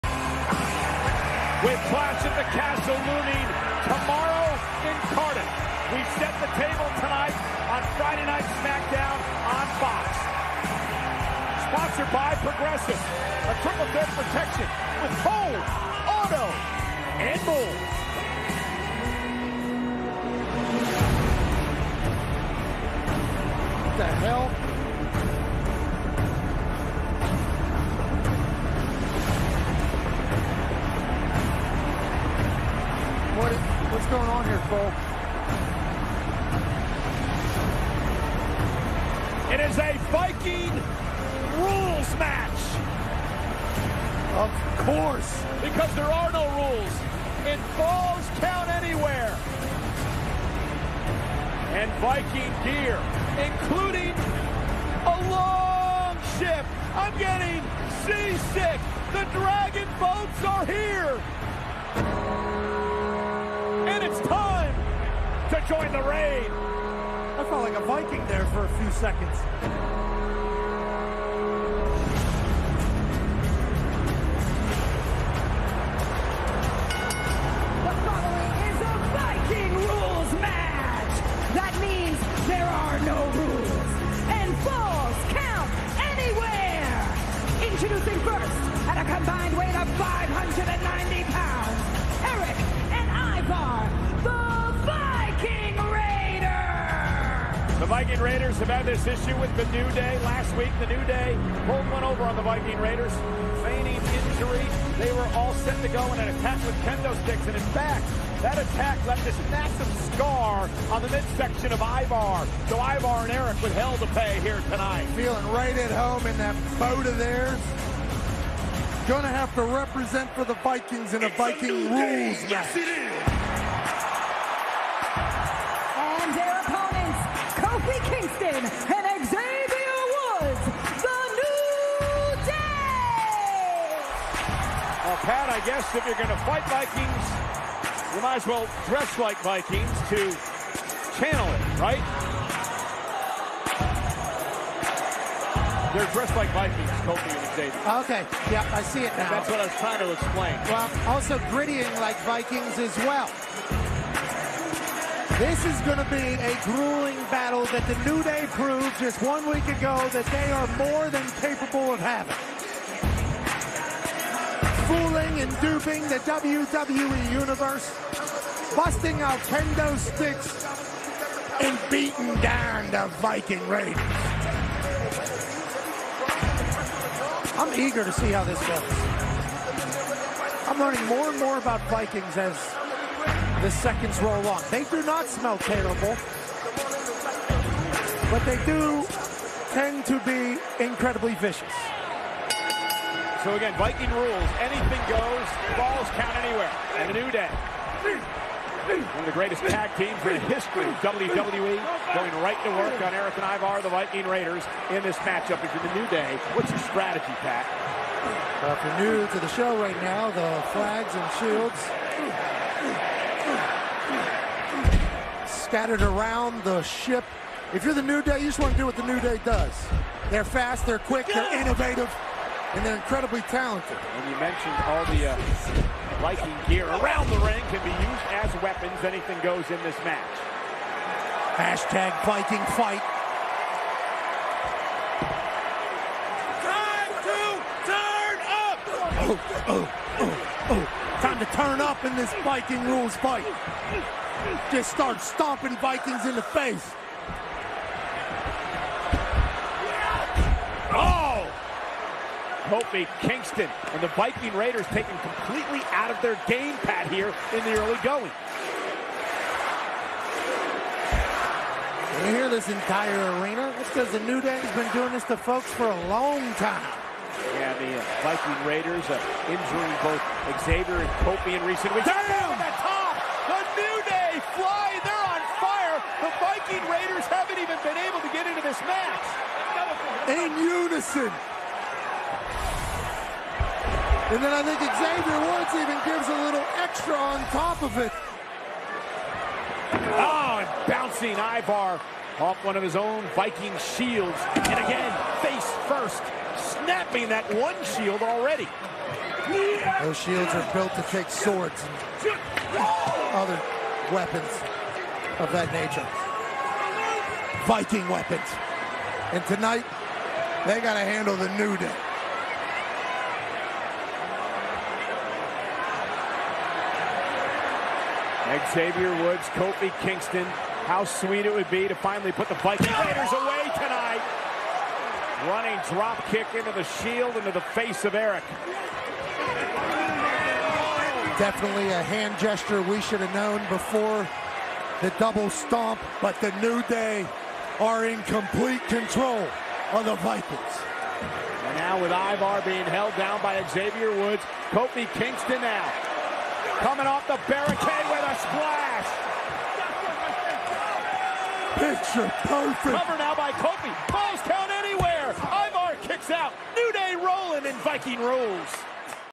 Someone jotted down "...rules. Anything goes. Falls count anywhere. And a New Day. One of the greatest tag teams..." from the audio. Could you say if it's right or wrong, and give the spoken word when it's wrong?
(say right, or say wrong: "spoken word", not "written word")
right.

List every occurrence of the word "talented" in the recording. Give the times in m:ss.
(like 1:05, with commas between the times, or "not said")
3:43.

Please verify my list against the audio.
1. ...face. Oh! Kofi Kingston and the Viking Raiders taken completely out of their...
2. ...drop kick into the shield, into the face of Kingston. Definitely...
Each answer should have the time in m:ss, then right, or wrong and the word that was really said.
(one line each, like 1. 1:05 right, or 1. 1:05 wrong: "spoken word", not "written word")
1. 4:06 right
2. 5:25 wrong: "Erik", not "Kingston".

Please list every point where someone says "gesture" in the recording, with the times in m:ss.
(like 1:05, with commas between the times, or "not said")
5:32.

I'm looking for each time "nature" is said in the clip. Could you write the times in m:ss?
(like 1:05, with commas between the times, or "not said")
5:05.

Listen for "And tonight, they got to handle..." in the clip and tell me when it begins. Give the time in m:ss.
5:09.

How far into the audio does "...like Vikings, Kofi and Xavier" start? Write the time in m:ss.
2:26.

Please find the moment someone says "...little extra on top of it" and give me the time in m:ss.
4:46.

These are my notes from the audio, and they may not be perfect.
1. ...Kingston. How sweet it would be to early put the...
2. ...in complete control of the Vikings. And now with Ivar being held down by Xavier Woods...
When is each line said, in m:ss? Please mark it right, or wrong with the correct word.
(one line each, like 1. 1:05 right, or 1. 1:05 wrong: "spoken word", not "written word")
1. 5:20 wrong: "finally", not "early"
2. 5:38 right.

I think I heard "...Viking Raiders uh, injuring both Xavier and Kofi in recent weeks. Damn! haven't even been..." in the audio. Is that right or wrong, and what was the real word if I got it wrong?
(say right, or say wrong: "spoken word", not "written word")
right.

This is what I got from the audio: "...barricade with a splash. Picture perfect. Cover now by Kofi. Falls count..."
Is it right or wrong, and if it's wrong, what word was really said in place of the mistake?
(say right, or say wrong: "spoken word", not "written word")
right.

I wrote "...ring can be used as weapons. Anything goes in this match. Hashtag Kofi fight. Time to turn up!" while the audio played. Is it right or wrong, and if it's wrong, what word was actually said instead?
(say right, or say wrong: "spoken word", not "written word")
wrong: "Viking", not "Kofi".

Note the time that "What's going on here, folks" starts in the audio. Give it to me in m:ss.
0:33.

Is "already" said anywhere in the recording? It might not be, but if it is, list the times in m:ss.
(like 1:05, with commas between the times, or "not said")
4:58.